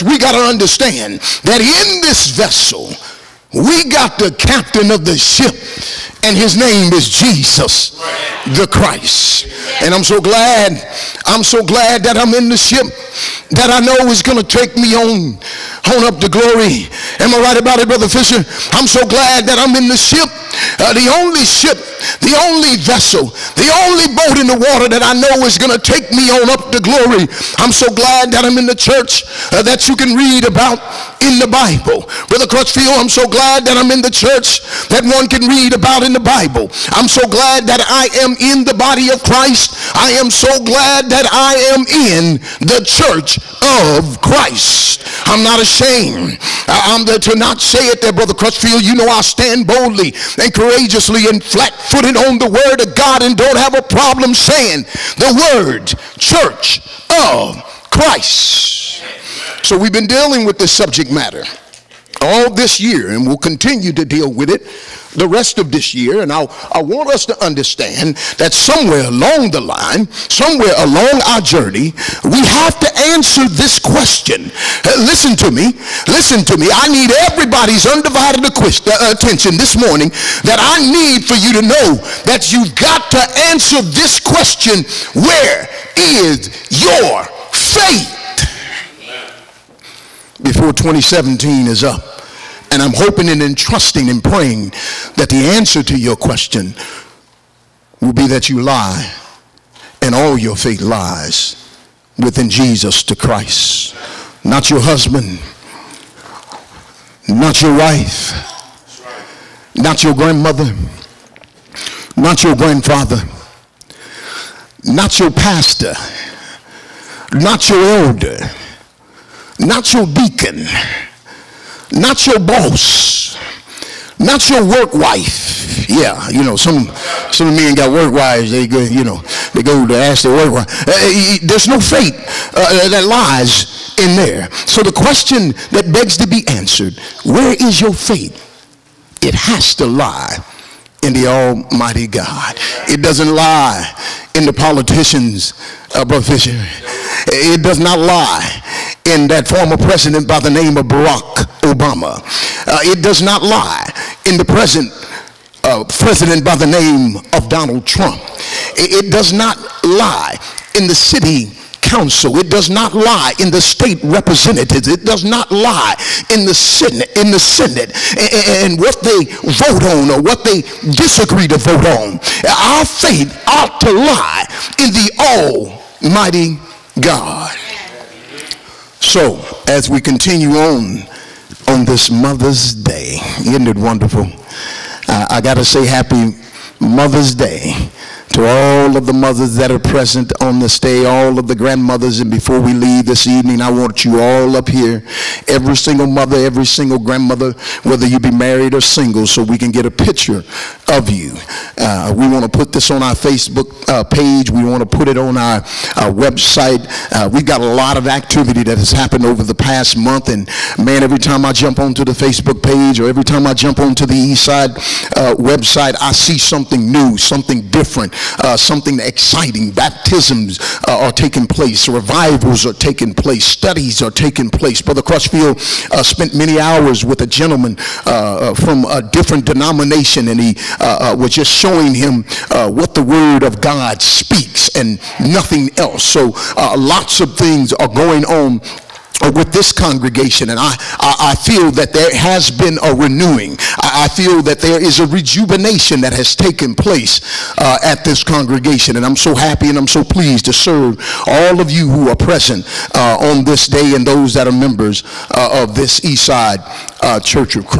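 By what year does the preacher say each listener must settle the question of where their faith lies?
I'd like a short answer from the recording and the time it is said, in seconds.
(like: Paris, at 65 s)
2017, at 90 s.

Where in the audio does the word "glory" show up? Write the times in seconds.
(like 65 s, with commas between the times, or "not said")
16 s, 26 s.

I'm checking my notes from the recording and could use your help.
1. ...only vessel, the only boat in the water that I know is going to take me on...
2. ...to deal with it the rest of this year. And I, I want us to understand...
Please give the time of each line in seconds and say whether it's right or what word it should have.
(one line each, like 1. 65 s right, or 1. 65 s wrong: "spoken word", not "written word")
1. 22 s right
2. 63 s right.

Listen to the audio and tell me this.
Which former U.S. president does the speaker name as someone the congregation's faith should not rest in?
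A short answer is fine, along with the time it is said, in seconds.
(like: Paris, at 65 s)
Barack Obama, at 150 s.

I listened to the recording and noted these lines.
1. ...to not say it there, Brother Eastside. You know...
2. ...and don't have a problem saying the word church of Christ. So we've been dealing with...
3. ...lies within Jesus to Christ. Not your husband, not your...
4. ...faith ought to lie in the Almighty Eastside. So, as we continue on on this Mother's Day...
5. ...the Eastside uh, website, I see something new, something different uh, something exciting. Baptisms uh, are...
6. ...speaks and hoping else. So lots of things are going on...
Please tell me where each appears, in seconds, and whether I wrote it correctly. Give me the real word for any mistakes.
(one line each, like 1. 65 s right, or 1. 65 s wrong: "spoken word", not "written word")
1. 47 s wrong: "Crutchfield", not "Eastside"
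2. 53 s right
3. 100 s right
4. 172 s wrong: "God", not "Eastside"
5. 214 s right
6. 234 s wrong: "nothing", not "hoping".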